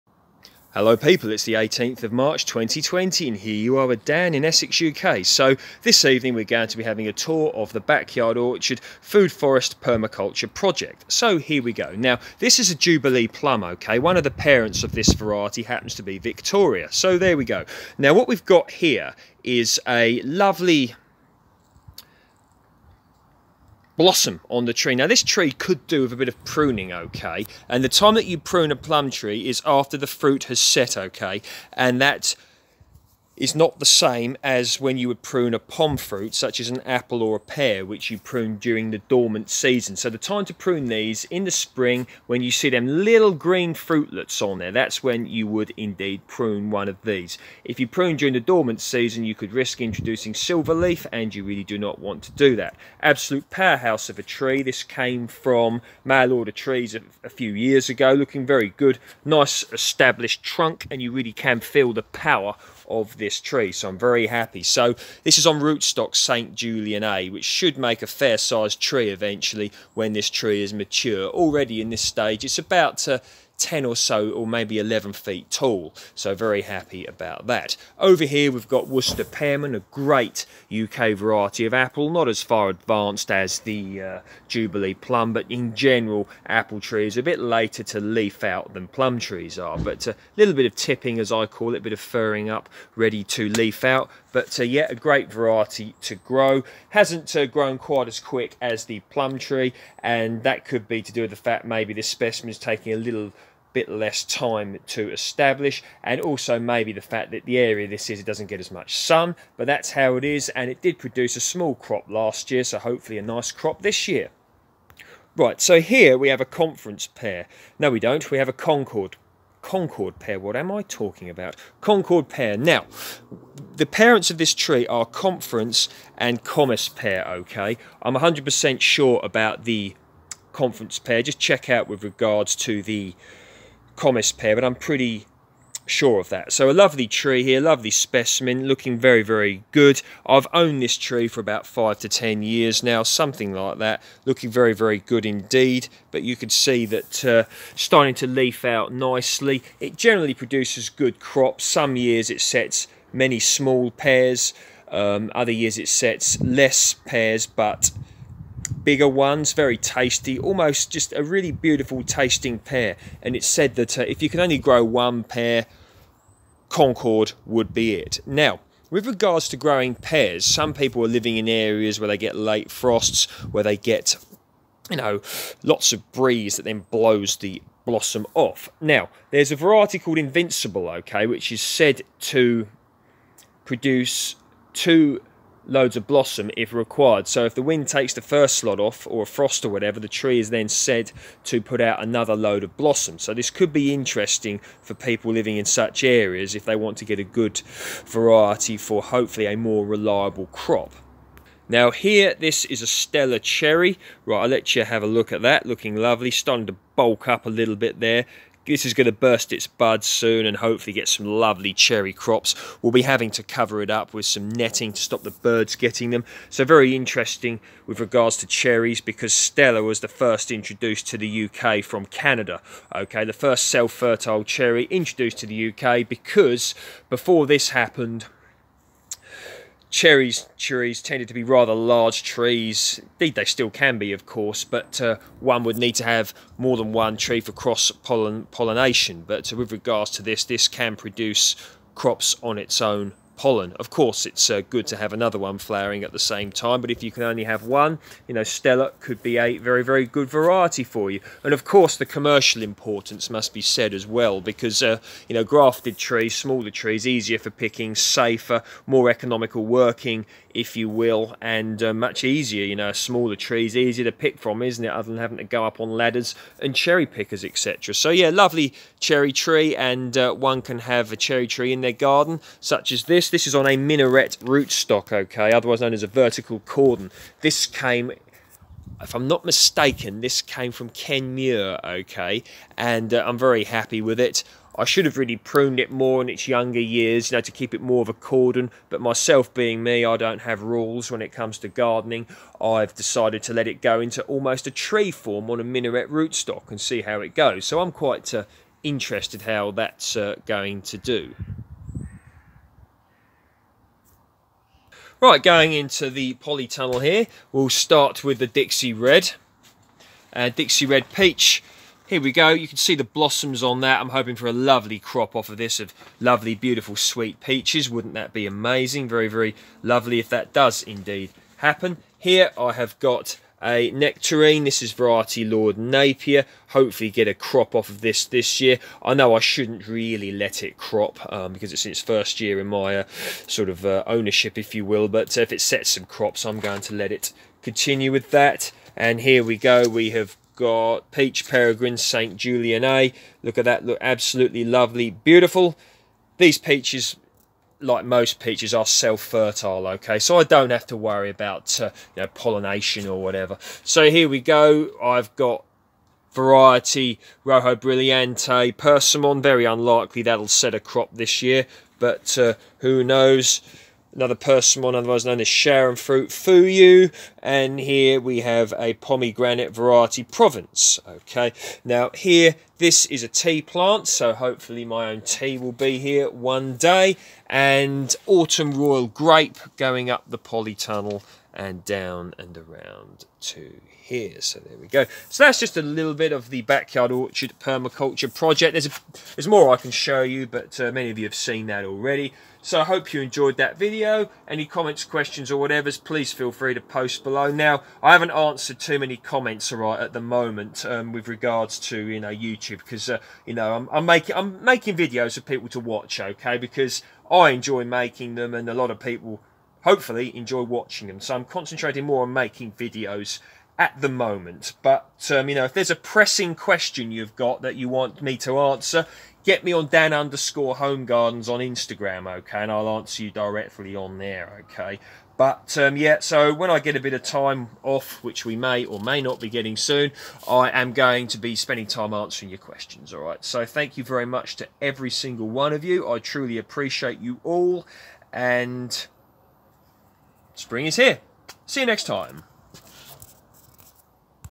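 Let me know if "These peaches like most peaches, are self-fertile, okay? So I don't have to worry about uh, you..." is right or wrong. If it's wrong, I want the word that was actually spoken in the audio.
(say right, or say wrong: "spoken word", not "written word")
right.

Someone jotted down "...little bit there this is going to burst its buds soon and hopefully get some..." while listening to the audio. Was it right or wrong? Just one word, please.
right.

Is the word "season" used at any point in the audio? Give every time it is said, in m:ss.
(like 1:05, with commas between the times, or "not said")
0:39, 0:48.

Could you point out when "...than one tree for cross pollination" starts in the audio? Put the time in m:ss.
3:56.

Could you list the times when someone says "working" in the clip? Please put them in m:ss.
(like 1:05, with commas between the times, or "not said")
4:19.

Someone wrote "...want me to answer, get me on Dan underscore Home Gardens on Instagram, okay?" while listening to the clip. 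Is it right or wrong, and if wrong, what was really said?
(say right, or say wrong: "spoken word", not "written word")
right.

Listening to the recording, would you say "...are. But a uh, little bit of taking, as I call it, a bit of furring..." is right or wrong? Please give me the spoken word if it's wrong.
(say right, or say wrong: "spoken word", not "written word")
wrong: "tipping", not "taking".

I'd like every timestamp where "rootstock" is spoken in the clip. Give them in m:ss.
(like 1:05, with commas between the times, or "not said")
1:05, 4:34, 4:56.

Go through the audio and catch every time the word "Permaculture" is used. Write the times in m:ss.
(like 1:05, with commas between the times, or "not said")
0:09, 6:27.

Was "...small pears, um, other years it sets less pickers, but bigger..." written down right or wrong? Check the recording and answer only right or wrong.
wrong.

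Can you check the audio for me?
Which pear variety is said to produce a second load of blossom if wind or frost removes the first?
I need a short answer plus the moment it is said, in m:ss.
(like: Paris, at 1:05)
Invincible, at 3:00.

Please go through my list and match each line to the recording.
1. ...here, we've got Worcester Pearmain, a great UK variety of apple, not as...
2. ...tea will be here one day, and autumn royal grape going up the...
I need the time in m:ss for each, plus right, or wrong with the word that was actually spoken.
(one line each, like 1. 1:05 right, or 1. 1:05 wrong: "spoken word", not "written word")
1. 1:18 right
2. 6:15 right.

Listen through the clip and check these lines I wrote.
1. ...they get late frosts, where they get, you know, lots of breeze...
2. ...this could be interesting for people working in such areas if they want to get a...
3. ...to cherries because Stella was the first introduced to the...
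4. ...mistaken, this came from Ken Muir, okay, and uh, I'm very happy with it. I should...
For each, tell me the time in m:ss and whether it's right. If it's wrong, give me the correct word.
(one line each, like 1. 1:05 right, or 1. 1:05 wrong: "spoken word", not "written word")
1. 2:52 right
2. 3:13 wrong: "living", not "working"
3. 3:38 right
4. 4:39 right.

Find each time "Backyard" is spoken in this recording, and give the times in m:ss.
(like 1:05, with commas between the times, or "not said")
0:07, 6:26.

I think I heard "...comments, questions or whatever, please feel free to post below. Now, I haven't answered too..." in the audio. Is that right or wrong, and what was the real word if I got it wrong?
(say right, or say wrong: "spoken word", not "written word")
right.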